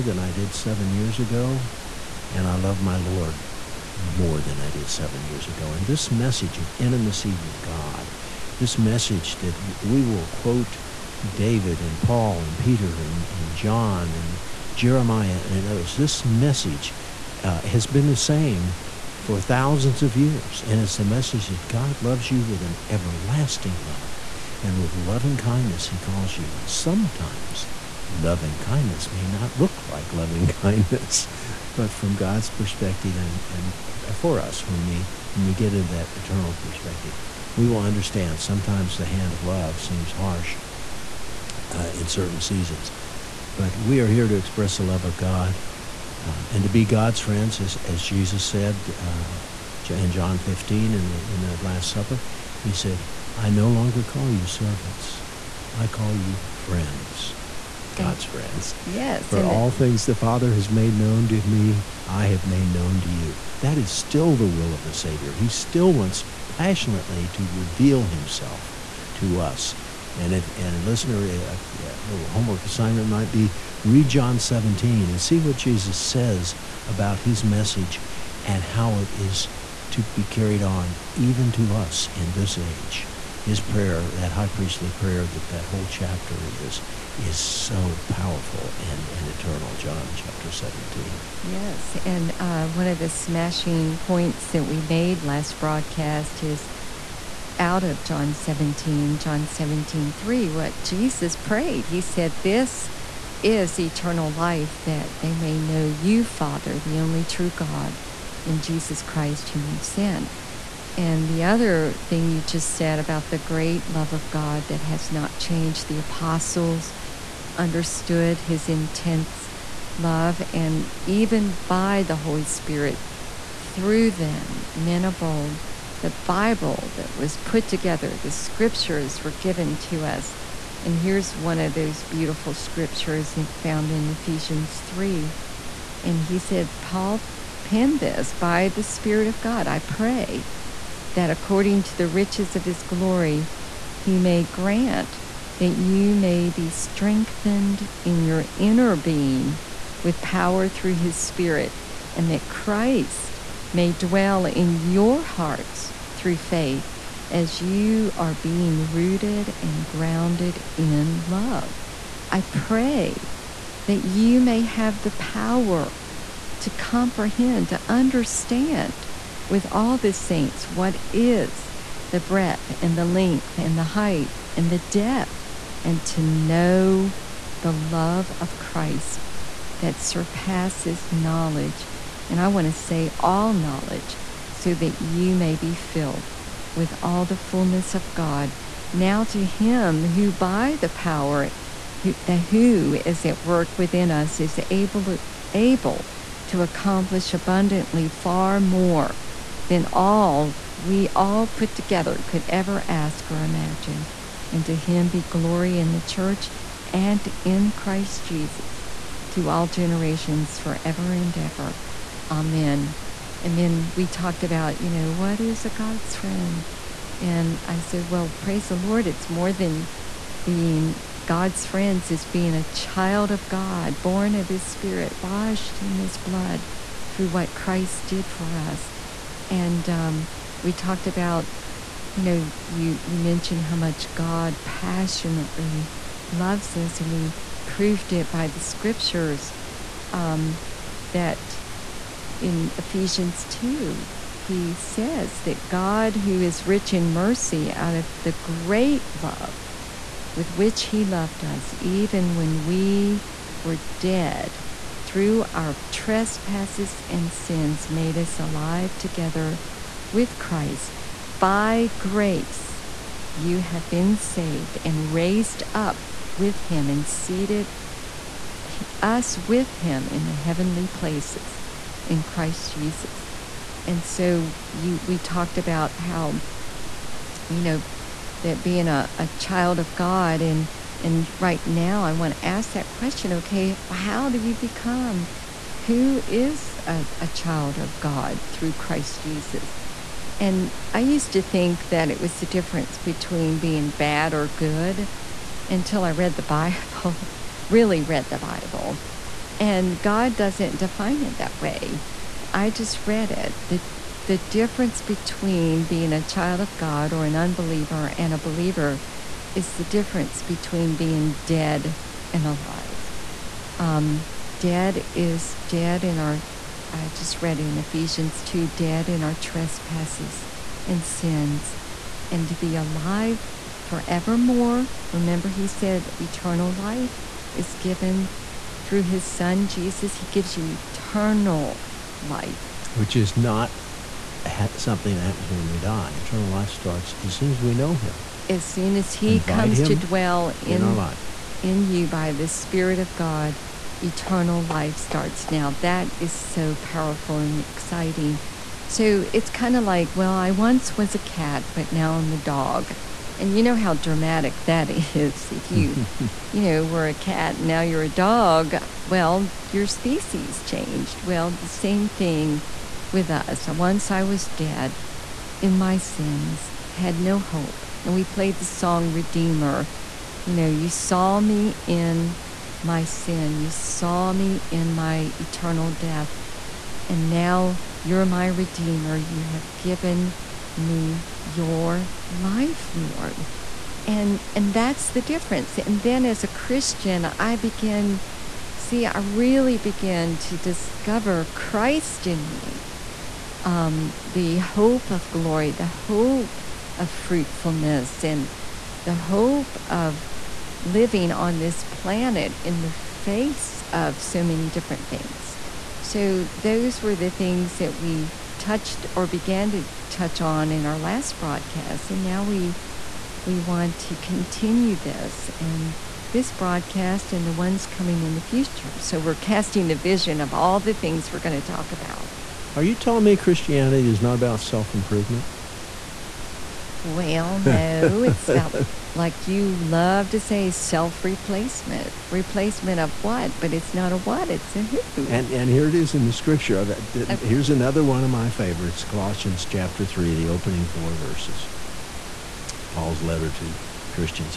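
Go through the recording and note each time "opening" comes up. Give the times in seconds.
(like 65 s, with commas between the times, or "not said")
440 s.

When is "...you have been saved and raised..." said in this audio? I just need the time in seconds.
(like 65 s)
263 s.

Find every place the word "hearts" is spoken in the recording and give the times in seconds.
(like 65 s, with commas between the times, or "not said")
155 s.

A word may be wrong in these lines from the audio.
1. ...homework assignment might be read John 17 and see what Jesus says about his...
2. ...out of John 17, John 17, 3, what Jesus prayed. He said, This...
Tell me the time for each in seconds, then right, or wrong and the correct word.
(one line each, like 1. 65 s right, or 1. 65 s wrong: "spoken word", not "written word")
1. 72 s right
2. 97 s right.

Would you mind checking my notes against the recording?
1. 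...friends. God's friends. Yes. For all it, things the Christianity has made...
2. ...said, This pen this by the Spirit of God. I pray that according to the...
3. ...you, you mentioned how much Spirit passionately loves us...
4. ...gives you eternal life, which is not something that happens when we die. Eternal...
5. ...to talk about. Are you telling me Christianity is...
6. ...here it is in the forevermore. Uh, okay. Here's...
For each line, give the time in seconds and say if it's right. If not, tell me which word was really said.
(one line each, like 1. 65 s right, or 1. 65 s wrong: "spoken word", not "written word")
1. 56 s wrong: "Father", not "Christianity"
2. 136 s wrong: "Paul", not "This"
3. 232 s wrong: "God", not "Spirit"
4. 330 s right
5. 421 s right
6. 435 s wrong: "scripture", not "forevermore".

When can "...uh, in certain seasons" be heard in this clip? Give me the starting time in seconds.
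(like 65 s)
41 s.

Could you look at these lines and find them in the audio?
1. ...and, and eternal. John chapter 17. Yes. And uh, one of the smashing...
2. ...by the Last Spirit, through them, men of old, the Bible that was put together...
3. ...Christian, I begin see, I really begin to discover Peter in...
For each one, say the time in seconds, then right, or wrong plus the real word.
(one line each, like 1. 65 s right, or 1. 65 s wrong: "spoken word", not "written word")
1. 88 s right
2. 121 s wrong: "Holy", not "Last"
3. 386 s wrong: "Christ", not "Peter".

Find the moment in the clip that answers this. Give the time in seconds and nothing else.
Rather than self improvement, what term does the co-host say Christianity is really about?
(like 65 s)
430 s.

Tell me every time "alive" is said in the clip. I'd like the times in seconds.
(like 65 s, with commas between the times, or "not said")
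258 s, 312 s, 322 s.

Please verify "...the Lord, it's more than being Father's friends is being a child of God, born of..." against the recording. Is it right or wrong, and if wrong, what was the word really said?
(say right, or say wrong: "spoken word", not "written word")
wrong: "God", not "Father".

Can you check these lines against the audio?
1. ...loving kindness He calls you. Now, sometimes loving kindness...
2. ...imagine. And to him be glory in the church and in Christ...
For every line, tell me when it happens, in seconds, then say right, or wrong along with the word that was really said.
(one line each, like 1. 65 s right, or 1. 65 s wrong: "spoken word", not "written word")
1. 24 s right
2. 203 s right.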